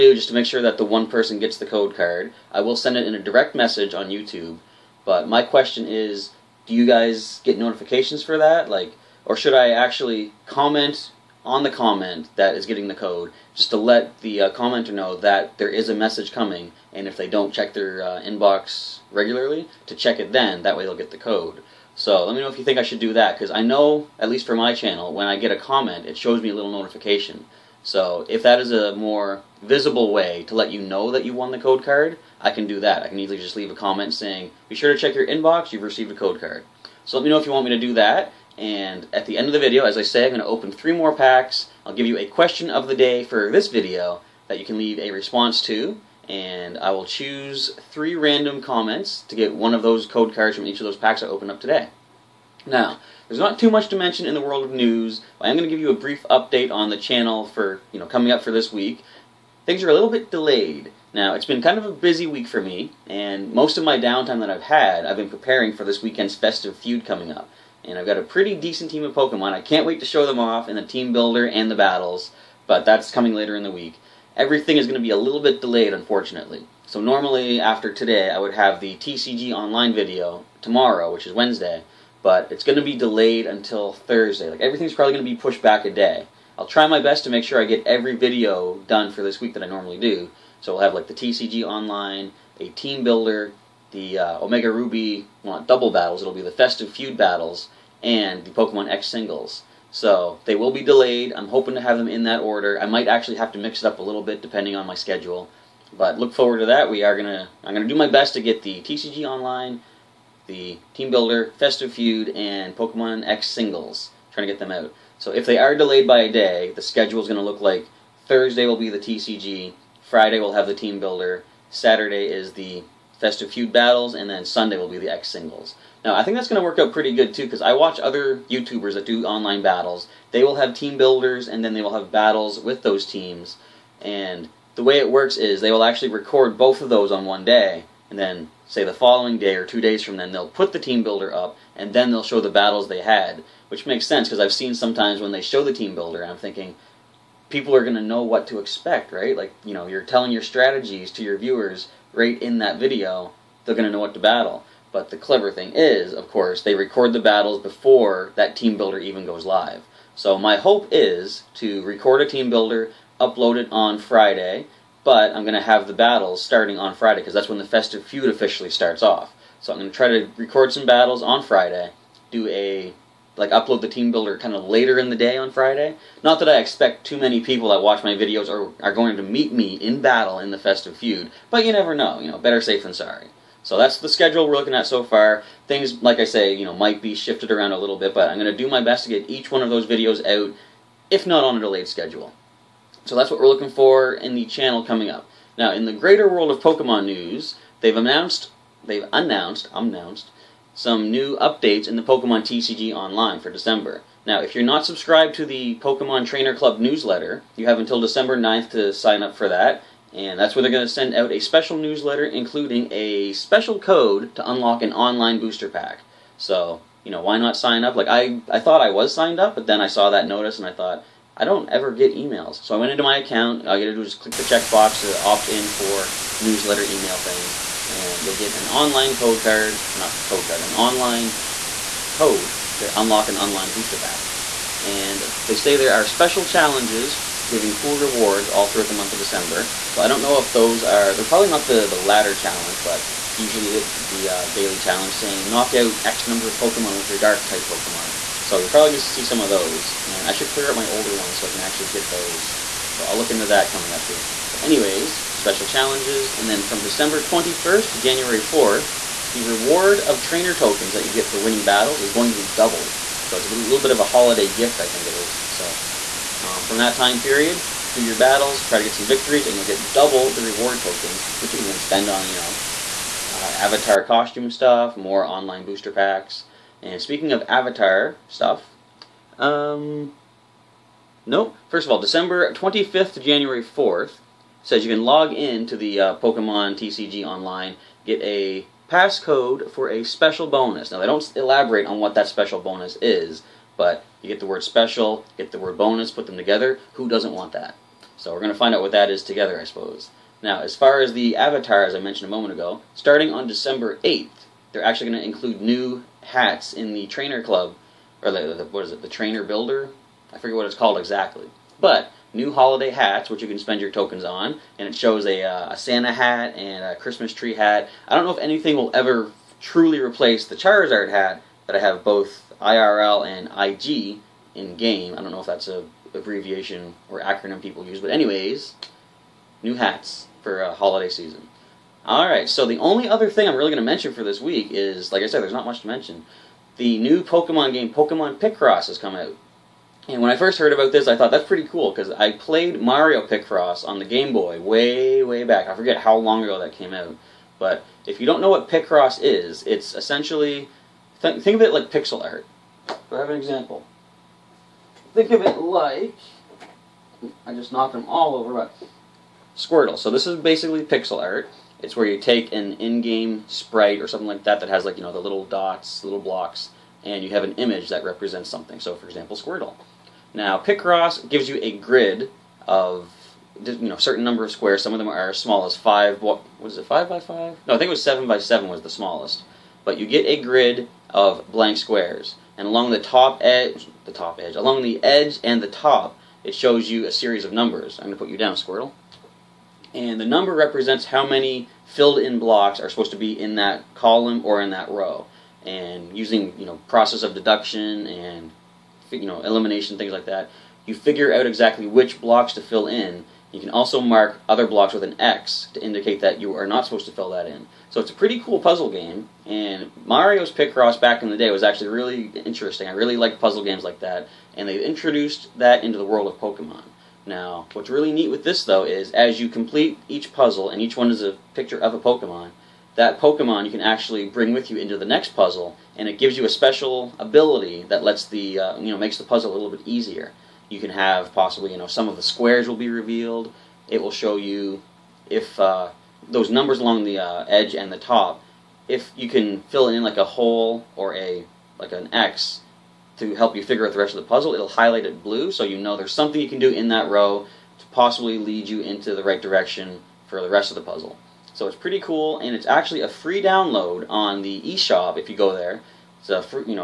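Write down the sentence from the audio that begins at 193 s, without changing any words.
So that's what we're looking for in the channel coming up.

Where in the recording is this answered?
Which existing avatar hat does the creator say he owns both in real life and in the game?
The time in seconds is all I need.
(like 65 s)
320 s.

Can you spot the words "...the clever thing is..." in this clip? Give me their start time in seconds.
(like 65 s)
155 s.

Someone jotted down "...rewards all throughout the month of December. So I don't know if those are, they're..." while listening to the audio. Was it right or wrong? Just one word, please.
right.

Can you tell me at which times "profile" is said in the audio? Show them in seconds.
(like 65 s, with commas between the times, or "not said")
not said.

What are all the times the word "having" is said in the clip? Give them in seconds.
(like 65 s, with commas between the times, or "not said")
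not said.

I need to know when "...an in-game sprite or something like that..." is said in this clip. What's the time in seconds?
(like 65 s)
362 s.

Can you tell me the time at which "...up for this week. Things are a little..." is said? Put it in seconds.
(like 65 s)
58 s.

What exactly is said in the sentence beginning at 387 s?
I'm gonna put you down, Squirtle.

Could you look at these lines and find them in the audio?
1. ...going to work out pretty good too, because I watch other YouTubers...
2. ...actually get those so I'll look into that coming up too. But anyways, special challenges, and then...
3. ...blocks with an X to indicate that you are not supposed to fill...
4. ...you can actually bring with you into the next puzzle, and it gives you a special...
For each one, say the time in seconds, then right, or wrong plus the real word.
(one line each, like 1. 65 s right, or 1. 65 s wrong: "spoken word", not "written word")
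1. 126 s right
2. 251 s right
3. 404 s right
4. 423 s right.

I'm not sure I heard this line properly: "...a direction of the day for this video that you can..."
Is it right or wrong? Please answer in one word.
wrong.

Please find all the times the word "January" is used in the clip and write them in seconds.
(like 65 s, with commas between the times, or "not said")
257 s, 283 s.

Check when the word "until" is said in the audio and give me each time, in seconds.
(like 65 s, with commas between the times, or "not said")
83 s, 207 s.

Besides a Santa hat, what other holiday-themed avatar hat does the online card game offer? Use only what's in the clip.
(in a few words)
Christmas tree hat.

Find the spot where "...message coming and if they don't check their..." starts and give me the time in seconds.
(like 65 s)
15 s.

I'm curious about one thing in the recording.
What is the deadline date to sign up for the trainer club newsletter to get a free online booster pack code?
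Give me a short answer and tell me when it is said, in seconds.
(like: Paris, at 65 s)
December 9th, at 208 s.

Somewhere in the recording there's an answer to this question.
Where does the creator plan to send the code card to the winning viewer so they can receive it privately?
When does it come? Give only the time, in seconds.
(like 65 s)
3 s.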